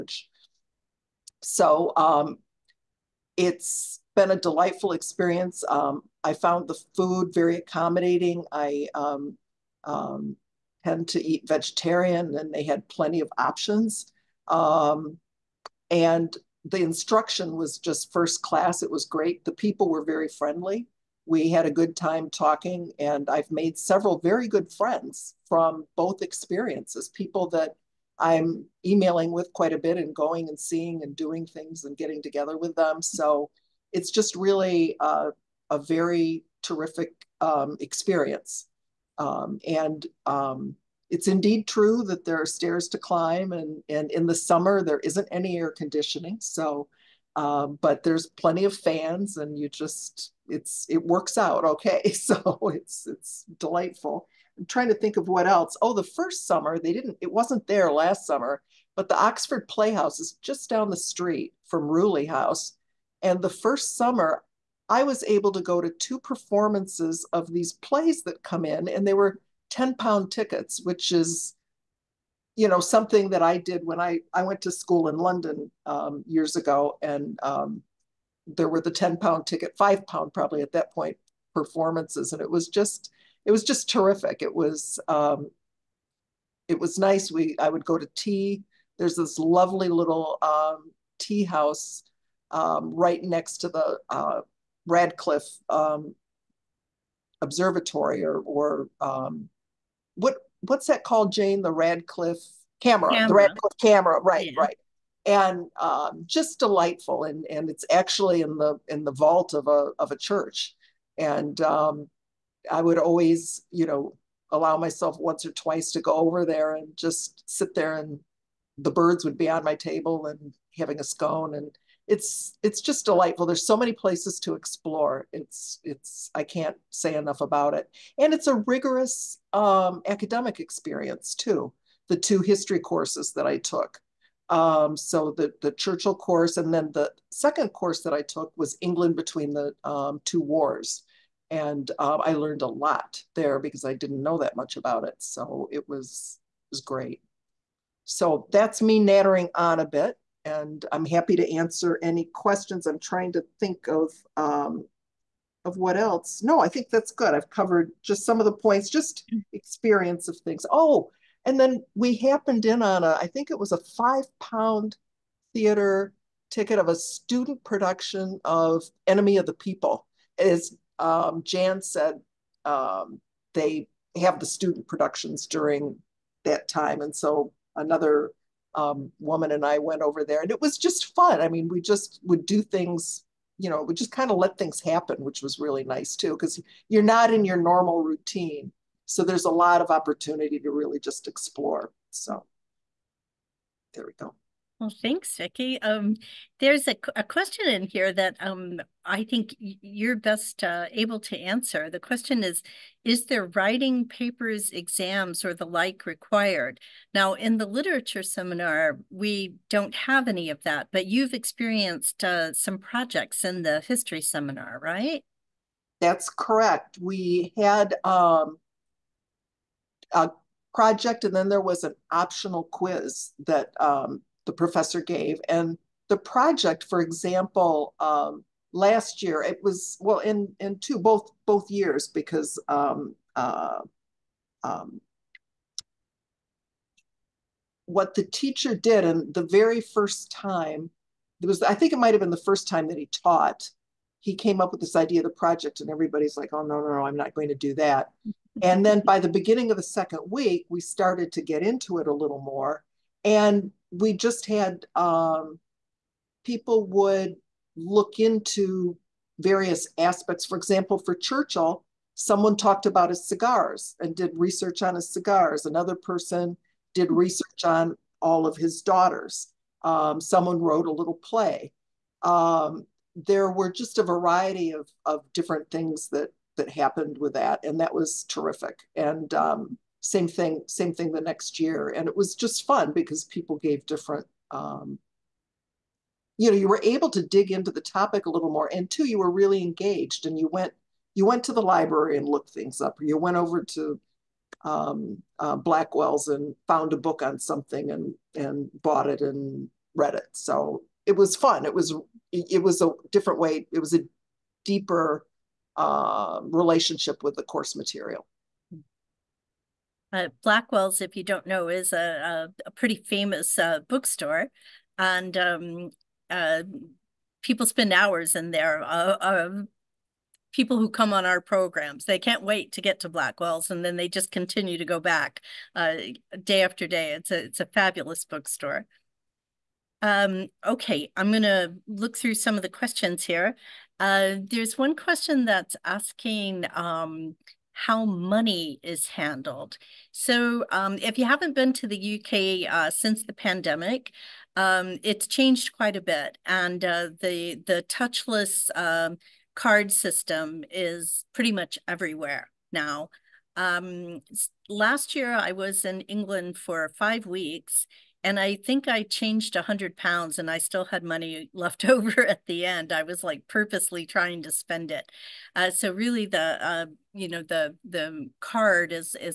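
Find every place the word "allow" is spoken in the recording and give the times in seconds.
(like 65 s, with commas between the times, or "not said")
114 s.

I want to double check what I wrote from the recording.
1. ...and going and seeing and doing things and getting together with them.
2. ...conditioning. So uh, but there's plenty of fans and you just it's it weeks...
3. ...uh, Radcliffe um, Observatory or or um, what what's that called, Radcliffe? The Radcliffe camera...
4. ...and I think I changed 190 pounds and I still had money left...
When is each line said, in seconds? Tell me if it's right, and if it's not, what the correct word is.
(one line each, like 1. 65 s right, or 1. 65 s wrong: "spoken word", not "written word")
1. 29 s right
2. 45 s wrong: "works", not "weeks"
3. 94 s wrong: "Jane", not "Radcliffe"
4. 358 s wrong: "100", not "190".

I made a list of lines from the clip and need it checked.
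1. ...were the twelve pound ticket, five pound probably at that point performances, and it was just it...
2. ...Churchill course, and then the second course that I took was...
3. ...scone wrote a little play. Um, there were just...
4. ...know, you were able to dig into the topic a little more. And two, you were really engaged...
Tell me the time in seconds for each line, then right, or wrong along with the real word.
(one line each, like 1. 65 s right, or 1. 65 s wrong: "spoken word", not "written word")
1. 78 s wrong: "ten", not "twelve"
2. 135 s right
3. 270 s wrong: "someone", not "scone"
4. 286 s right.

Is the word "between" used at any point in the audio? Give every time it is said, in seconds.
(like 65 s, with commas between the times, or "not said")
139 s.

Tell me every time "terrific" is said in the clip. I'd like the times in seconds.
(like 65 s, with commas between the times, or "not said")
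36 s, 83 s, 278 s.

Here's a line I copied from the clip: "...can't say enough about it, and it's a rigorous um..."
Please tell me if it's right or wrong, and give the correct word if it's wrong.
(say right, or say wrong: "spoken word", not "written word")
right.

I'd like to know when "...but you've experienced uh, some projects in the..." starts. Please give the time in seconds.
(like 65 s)
210 s.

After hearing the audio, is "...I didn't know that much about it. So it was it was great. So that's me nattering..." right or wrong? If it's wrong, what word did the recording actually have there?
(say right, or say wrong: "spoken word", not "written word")
right.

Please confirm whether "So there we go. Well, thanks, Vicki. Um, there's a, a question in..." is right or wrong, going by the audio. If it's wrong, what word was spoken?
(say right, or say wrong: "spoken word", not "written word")
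right.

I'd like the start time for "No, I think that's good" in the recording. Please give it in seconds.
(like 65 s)
156 s.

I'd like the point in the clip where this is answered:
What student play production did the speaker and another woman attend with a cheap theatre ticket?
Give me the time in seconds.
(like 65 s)
169 s.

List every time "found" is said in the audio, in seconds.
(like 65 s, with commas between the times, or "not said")
6 s, 296 s.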